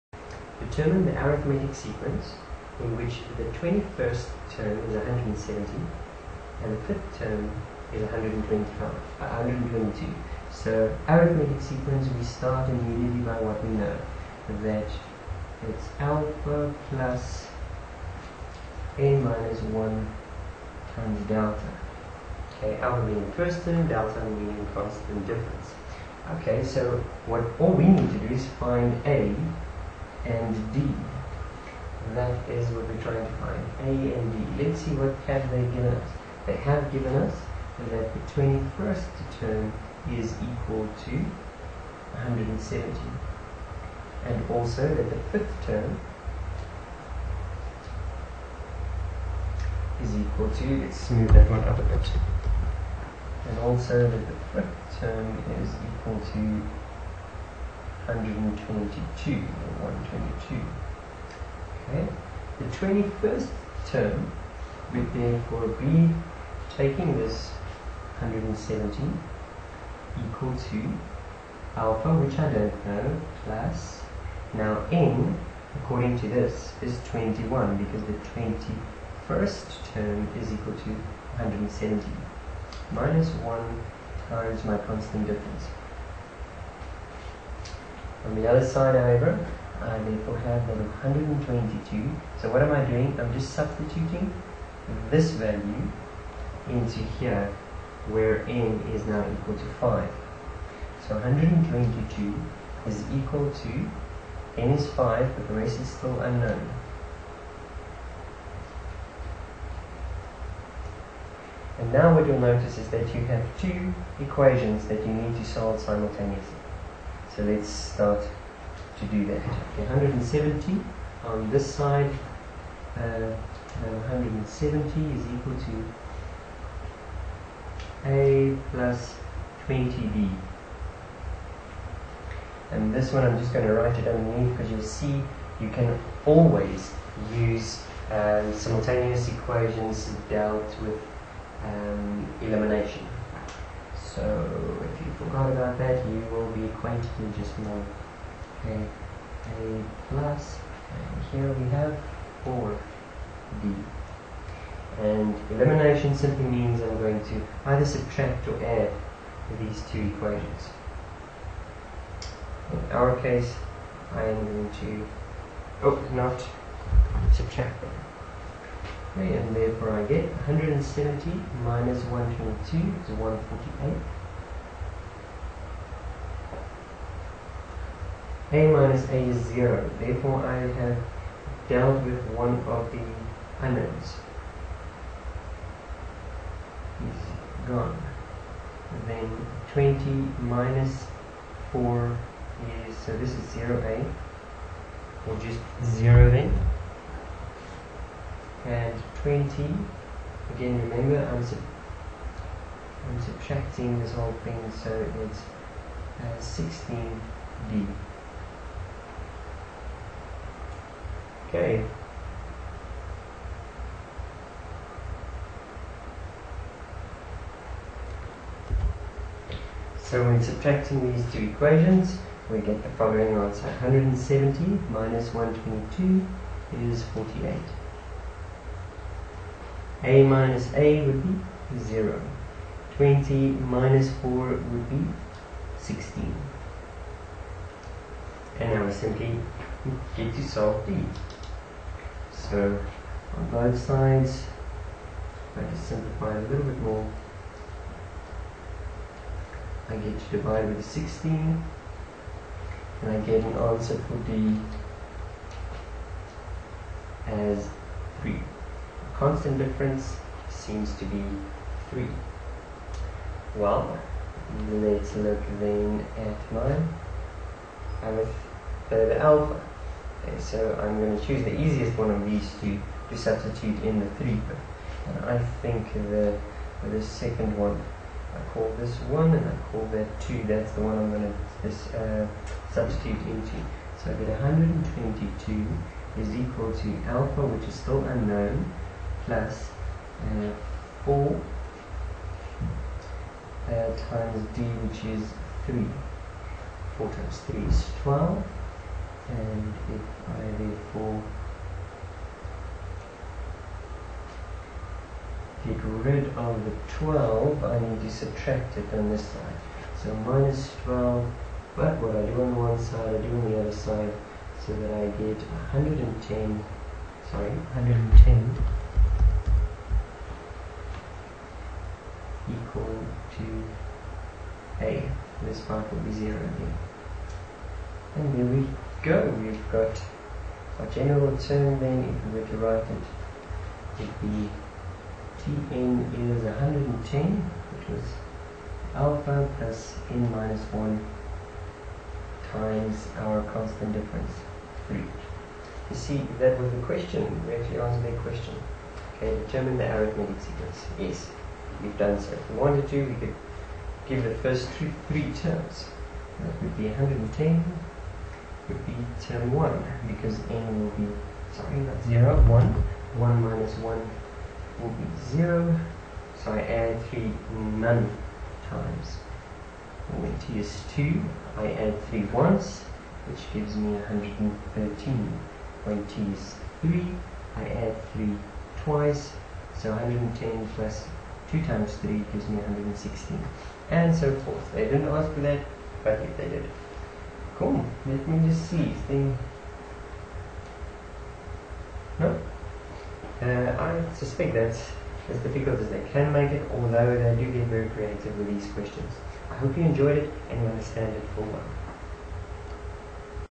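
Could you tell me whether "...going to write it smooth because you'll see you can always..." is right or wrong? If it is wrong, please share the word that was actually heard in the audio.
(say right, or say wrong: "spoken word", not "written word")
wrong: "underneath", not "smooth".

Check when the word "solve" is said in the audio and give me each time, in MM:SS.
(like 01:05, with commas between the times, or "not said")
01:55, 04:00.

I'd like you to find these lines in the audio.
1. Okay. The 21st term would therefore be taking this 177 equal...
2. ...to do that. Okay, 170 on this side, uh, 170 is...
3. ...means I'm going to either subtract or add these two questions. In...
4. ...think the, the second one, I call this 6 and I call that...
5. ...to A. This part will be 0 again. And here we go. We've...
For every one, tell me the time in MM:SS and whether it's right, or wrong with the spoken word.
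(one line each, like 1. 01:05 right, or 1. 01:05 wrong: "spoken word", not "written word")
1. 01:01 wrong: "170", not "177"
2. 01:58 right
3. 02:36 wrong: "equations", not "questions"
4. 04:35 wrong: "1", not "6"
5. 05:23 right.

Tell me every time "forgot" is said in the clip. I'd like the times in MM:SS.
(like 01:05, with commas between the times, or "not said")
02:25.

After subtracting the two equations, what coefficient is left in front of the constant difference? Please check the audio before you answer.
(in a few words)
16.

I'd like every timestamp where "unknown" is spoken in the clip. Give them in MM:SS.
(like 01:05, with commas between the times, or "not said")
01:46, 03:03, 04:48.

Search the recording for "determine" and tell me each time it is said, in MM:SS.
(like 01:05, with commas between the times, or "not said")
00:00, 05:49.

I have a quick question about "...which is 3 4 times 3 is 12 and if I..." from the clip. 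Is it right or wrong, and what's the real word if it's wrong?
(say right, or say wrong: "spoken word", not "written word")
right.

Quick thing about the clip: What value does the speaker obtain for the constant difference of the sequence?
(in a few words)
3.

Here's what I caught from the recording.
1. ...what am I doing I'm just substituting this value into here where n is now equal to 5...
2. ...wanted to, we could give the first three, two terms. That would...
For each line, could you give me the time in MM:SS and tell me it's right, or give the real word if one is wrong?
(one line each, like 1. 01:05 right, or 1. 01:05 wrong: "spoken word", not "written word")
1. 01:32 right
2. 05:52 wrong: "three", not "two".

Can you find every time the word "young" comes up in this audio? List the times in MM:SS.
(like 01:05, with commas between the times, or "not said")
not said.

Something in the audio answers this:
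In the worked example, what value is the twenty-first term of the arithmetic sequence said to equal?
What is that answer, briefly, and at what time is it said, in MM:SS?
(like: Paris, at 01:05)
170, at 00:03.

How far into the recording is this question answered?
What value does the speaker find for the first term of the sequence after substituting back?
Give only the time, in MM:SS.
05:17.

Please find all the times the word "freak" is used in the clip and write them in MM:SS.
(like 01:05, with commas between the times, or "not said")
not said.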